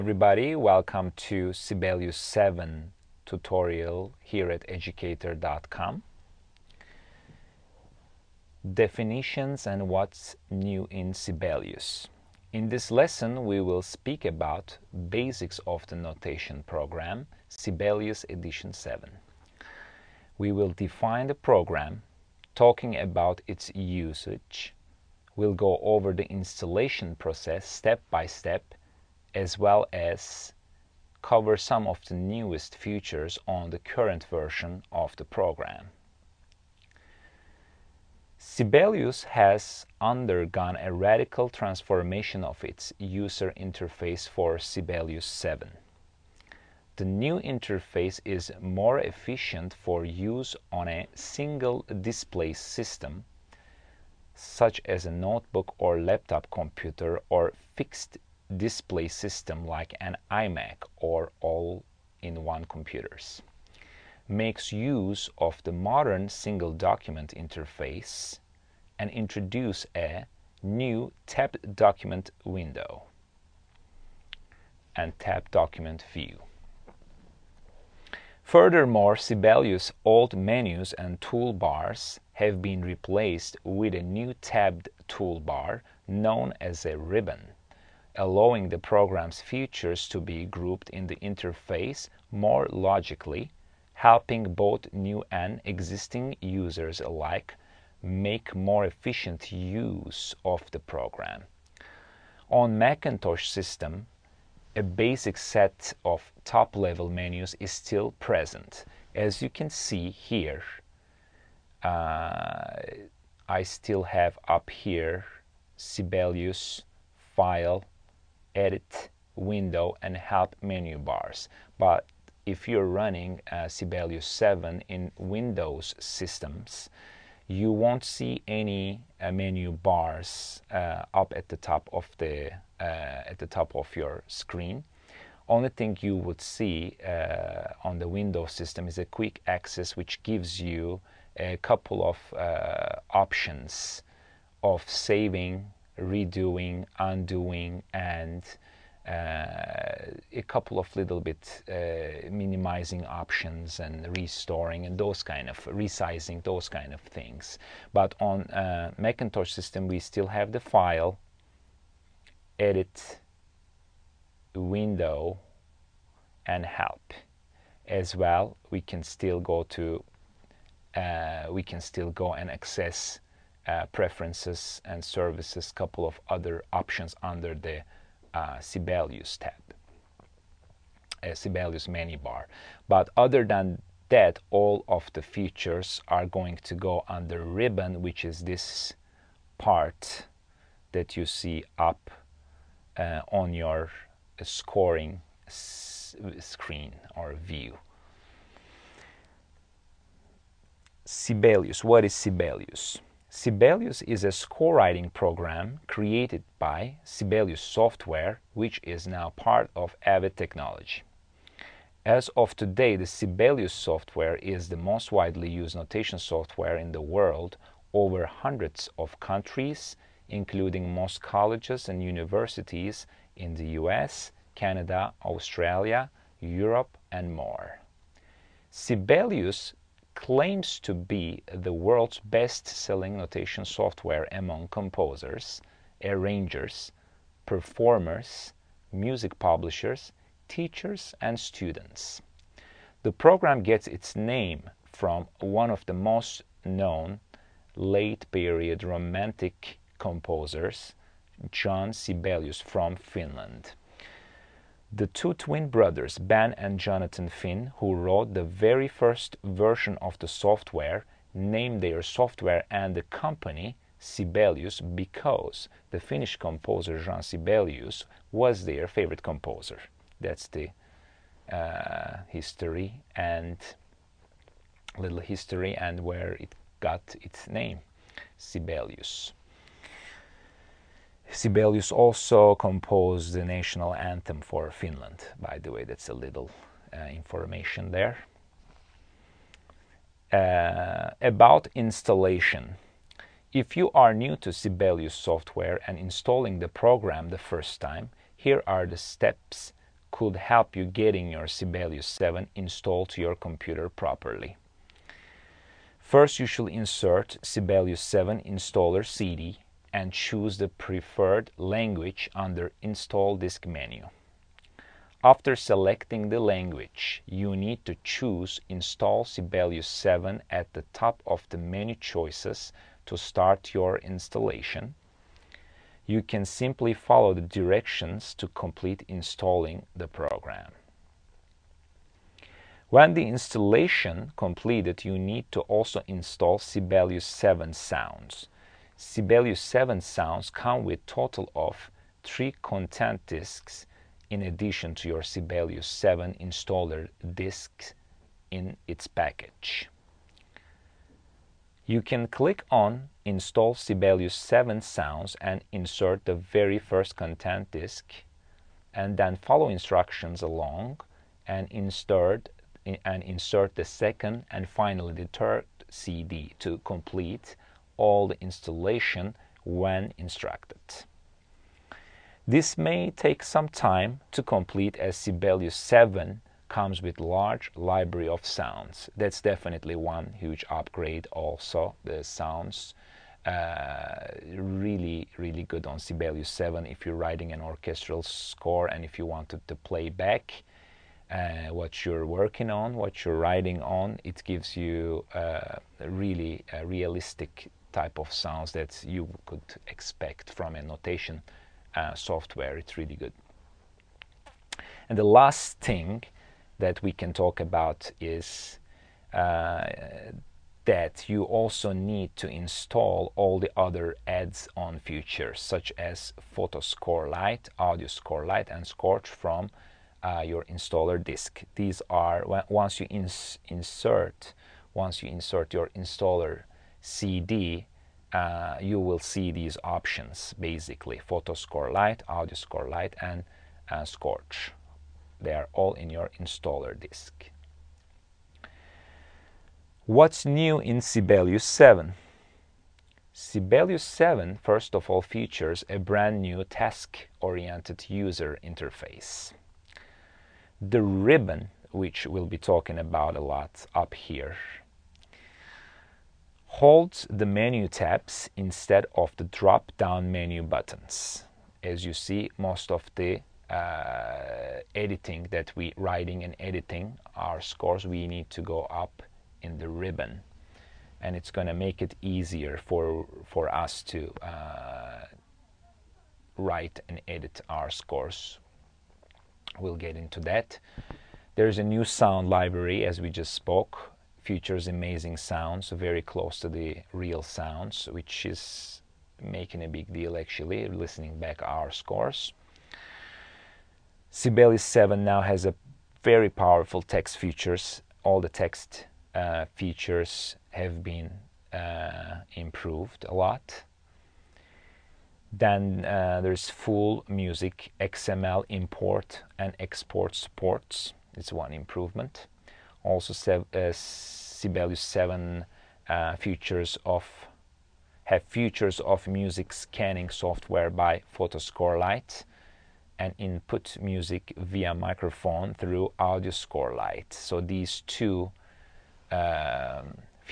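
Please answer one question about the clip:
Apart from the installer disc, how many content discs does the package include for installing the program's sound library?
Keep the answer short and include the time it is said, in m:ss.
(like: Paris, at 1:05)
3, at 5:42.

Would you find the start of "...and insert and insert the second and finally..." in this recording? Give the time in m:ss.
6:01.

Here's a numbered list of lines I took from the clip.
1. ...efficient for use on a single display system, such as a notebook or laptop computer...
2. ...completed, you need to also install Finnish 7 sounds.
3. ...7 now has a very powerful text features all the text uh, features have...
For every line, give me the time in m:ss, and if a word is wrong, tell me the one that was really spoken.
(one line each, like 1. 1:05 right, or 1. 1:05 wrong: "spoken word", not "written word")
1. 0:48 right
2. 5:34 wrong: "Sibelius", not "Finnish"
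3. 8:14 right.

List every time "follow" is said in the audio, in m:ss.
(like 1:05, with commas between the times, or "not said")
5:26, 5:59.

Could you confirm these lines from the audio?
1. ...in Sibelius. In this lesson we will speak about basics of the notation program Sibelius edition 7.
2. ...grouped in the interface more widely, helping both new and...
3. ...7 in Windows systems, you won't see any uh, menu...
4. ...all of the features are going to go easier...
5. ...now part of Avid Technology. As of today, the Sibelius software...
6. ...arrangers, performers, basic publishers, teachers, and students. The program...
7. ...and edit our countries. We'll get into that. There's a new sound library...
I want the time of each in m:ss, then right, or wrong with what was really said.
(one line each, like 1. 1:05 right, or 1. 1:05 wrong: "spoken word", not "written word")
1. 0:10 right
2. 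1:30 wrong: "logically", not "widely"
3. 2:04 right
4. 3:04 wrong: "under", not "easier"
5. 3:29 right
6. 3:56 wrong: "music", not "basic"
7. 7:57 wrong: "scores", not "countries".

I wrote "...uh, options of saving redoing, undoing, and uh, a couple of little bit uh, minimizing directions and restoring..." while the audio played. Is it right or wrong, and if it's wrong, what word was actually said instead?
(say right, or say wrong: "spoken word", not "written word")
wrong: "options", not "directions".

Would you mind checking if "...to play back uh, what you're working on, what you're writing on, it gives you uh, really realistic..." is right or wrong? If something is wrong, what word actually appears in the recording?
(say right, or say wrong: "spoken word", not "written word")
right.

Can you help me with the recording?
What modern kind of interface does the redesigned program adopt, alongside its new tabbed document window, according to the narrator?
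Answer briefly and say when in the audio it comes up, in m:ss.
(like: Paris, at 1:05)
single document interface, at 1:06.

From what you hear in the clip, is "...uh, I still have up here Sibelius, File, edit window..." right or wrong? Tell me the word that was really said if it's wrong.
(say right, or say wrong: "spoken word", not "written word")
right.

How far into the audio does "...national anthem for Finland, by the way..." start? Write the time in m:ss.
4:43.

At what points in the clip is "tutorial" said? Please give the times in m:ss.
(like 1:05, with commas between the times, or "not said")
0:03.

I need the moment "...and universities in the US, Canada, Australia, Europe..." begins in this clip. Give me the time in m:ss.
3:41.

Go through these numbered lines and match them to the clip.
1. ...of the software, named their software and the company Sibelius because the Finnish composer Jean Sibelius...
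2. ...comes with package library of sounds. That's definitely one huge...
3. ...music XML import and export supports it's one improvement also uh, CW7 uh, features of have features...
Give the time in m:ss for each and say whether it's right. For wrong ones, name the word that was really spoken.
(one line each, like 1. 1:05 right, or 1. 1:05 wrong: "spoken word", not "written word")
1. 4:19 right
2. 6:16 wrong: "large", not "package"
3. 8:27 right.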